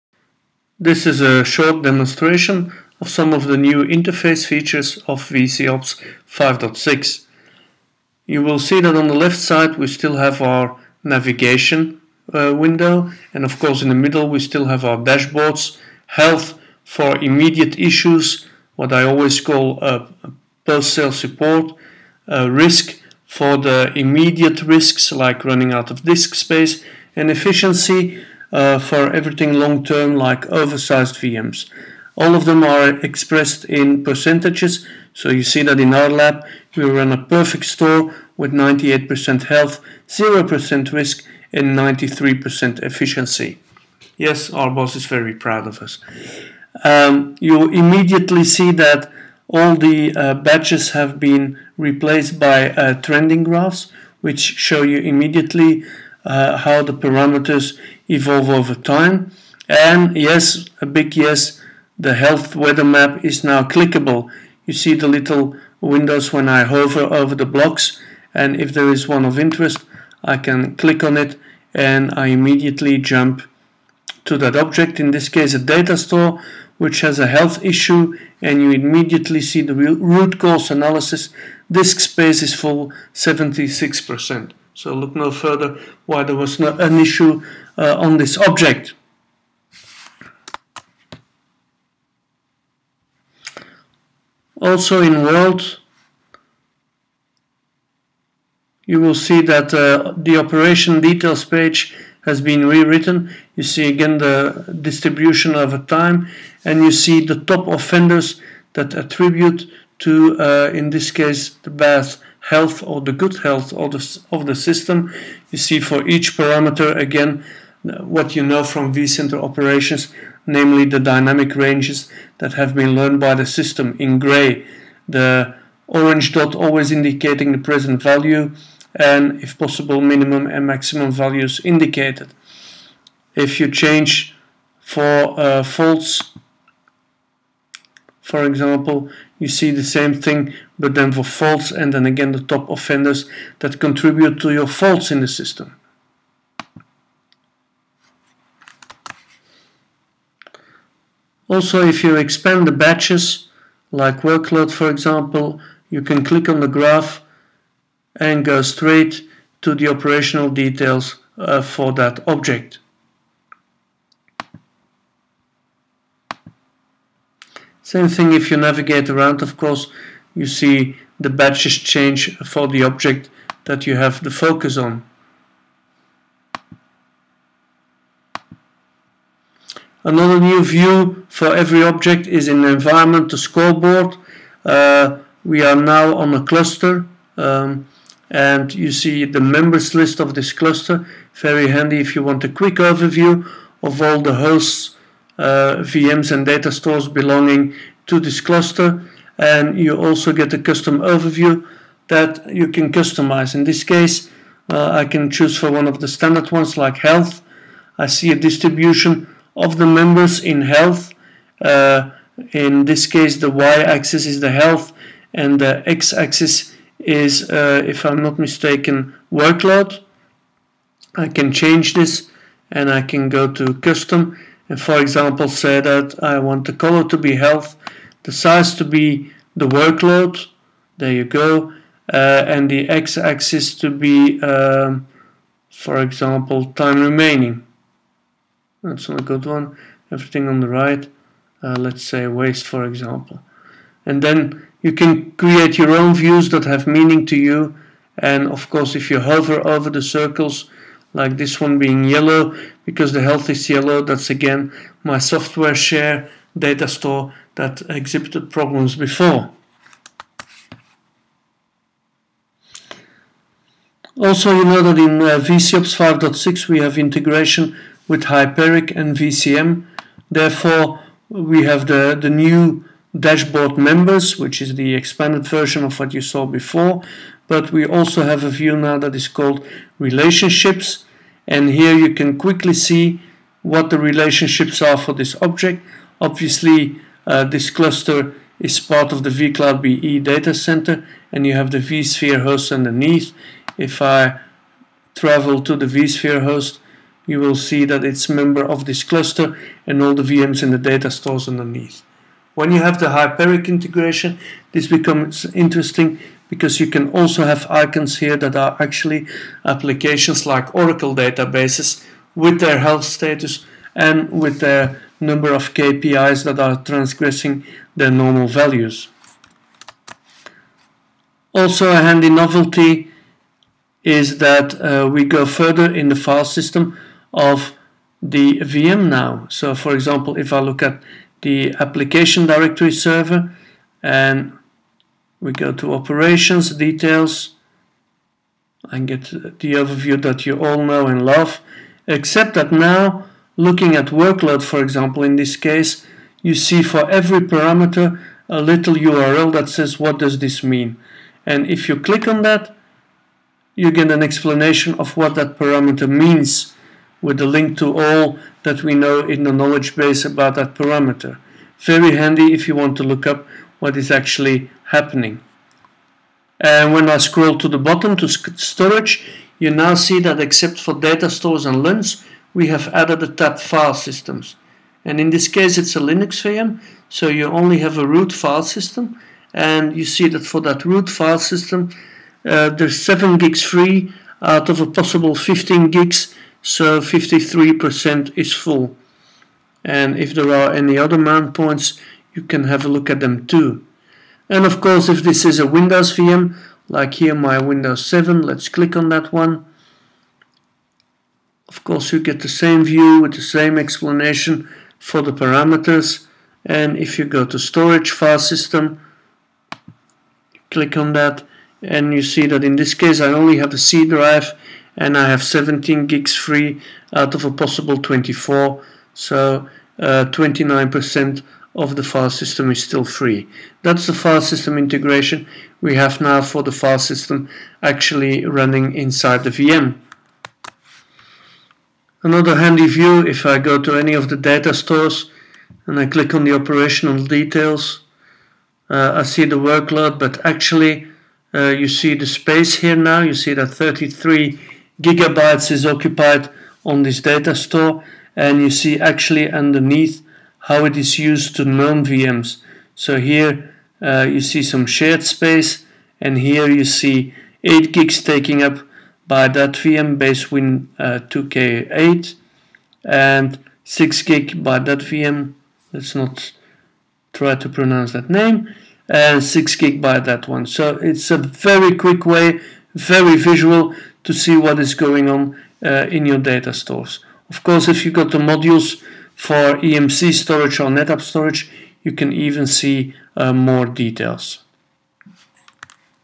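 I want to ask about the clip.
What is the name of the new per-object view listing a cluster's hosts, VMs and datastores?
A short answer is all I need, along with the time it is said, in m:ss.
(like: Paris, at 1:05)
Scoreboard, at 3:03.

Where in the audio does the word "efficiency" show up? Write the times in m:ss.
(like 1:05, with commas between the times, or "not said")
0:27, 0:42.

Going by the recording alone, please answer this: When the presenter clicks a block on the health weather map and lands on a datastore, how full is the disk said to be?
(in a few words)
76%.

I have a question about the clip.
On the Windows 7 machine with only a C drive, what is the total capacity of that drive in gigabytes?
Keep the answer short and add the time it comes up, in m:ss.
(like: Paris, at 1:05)
24, at 6:57.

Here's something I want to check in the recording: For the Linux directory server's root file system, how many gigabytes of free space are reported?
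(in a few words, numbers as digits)
7 gigs.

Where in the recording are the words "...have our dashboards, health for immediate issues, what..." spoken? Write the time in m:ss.
0:14.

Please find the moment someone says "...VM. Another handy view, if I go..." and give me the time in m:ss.
7:09.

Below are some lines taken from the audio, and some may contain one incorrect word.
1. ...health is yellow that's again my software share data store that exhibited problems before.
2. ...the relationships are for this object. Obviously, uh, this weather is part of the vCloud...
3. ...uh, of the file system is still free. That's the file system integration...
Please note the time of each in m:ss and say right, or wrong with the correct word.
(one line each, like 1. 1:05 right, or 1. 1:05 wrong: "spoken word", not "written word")
1. 4:13 right
2. 4:43 wrong: "cluster", not "weather"
3. 7:01 right.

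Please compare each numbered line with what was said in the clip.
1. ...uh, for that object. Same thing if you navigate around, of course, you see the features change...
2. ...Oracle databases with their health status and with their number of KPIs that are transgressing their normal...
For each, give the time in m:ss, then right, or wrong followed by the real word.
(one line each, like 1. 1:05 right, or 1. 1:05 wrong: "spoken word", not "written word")
1. 2:41 wrong: "badges", not "features"
2. 5:10 right.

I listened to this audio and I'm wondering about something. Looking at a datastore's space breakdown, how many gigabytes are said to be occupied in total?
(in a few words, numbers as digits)
33 gigabytes.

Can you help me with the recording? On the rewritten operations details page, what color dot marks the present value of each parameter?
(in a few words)
Orange.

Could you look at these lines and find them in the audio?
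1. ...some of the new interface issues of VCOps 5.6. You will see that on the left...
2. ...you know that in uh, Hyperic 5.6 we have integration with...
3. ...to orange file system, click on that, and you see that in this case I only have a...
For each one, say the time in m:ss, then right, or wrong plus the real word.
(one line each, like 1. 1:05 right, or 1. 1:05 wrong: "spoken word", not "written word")
1. 0:03 wrong: "features", not "issues"
2. 4:24 wrong: "VCOps", not "Hyperic"
3. 6:47 wrong: "storage", not "orange".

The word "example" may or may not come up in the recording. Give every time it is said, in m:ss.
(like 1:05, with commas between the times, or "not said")
2:18, 2:34, 3:45, 3:56, 4:02, 5:29, 5:44.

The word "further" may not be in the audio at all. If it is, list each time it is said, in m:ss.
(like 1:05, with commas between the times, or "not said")
1:25, 5:25.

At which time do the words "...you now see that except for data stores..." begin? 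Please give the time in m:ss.
6:09.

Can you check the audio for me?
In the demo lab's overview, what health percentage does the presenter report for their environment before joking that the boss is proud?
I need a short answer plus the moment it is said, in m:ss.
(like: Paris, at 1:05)
98%, at 0:38.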